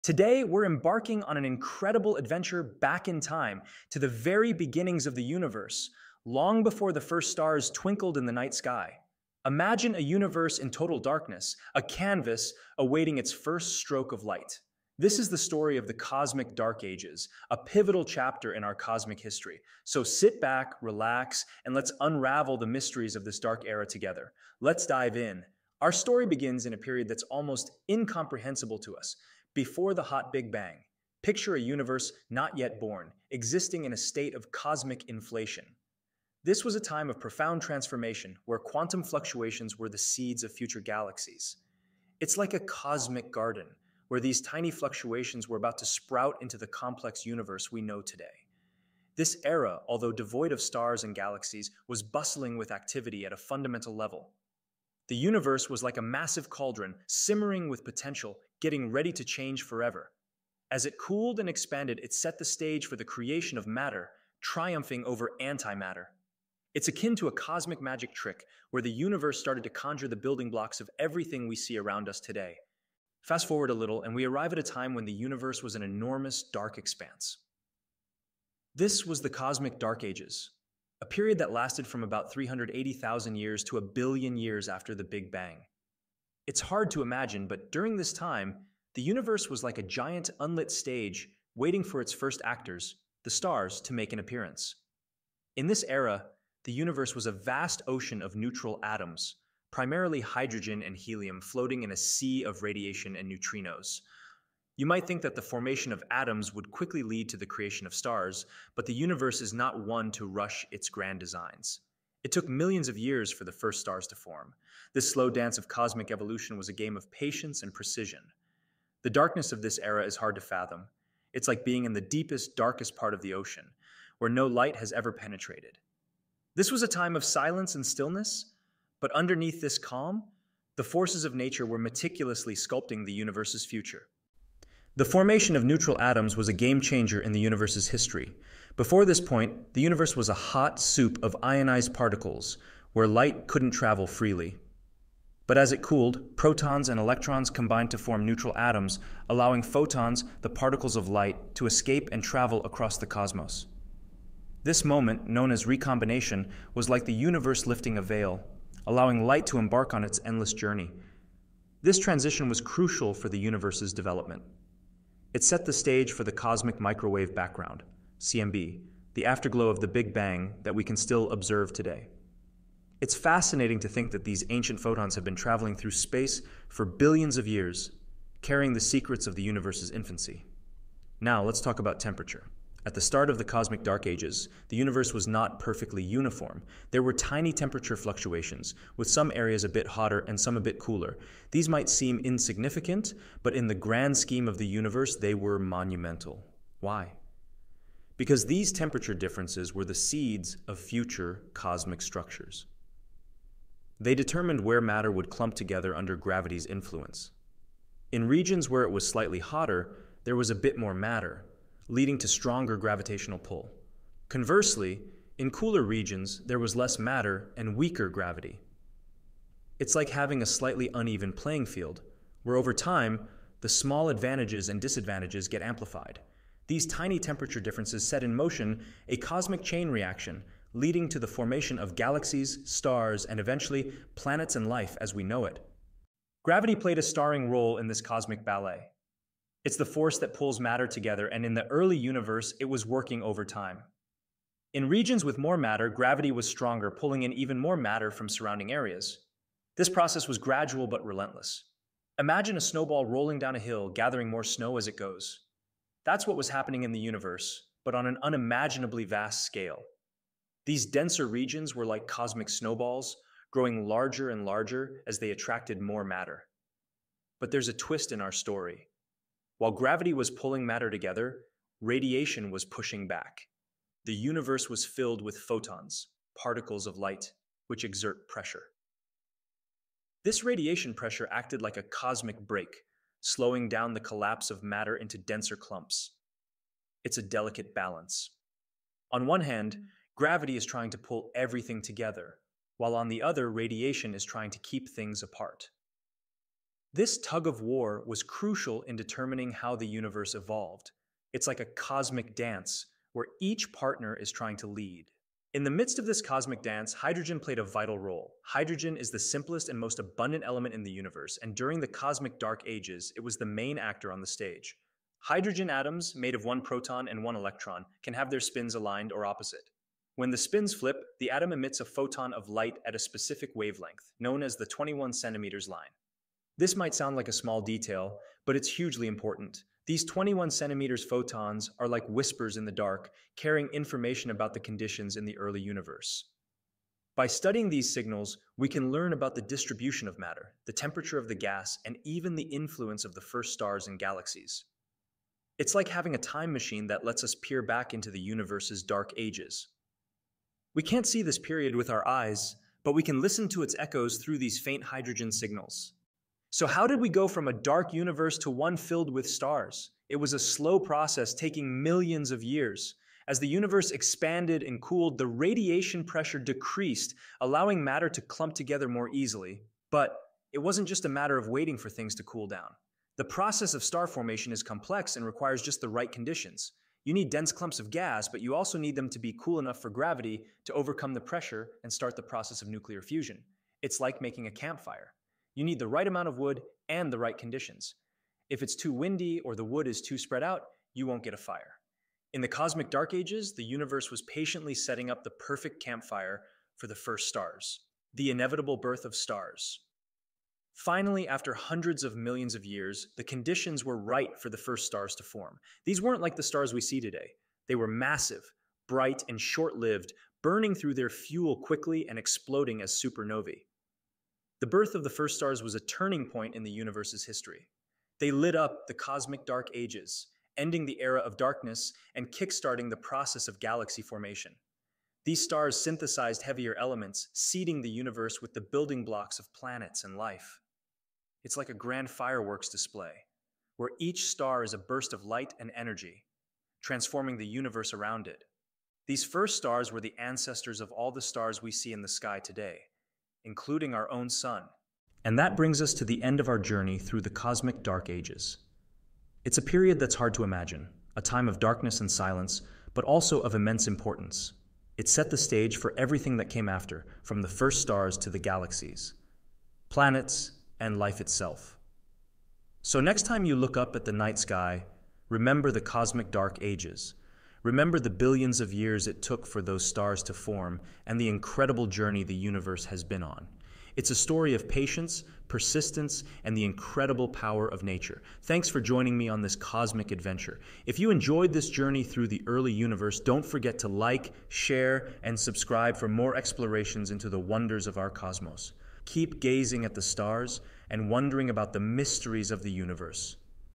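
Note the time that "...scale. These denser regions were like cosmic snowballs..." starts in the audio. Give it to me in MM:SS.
04:19.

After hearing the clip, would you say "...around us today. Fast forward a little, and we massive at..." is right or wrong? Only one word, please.
wrong.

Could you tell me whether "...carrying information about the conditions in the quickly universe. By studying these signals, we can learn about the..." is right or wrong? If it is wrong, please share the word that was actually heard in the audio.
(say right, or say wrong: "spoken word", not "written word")
wrong: "early", not "quickly".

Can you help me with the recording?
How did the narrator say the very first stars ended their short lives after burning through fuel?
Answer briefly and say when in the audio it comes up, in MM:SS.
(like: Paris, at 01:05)
exploding as supernovae, at 06:52.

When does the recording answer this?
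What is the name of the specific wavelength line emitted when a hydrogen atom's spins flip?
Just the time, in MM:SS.
05:24.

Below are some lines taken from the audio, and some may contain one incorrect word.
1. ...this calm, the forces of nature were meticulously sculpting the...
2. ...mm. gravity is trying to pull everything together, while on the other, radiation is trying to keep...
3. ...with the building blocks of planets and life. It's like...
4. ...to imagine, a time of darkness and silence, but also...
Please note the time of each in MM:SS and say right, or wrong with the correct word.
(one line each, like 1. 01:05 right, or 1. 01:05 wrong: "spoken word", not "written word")
1. 02:09 right
2. 04:49 right
3. 07:08 right
4. 07:30 right.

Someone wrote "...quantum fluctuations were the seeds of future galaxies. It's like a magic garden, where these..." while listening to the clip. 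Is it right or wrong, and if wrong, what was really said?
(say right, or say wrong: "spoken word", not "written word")
wrong: "cosmic", not "magic".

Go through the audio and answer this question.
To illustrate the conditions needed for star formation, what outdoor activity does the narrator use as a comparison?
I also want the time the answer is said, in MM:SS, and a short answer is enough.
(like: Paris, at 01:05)
making a campfire, at 06:24.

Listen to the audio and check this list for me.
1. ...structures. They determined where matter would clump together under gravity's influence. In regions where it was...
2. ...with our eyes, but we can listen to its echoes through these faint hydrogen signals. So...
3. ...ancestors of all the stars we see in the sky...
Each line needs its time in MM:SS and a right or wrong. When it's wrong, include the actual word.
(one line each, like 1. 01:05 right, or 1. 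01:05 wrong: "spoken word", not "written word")
1. 03:22 right
2. 05:51 right
3. 07:20 right.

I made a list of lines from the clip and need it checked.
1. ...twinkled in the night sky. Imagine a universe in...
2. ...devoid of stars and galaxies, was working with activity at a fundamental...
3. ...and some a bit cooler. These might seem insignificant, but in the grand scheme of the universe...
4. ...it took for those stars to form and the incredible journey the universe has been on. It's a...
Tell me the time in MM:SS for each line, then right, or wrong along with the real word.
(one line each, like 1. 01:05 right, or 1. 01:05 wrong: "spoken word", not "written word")
1. 00:07 right
2. 00:50 wrong: "bustling", not "working"
3. 03:10 right
4. 07:49 right.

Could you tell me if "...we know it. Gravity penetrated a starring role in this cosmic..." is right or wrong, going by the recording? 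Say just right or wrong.
wrong.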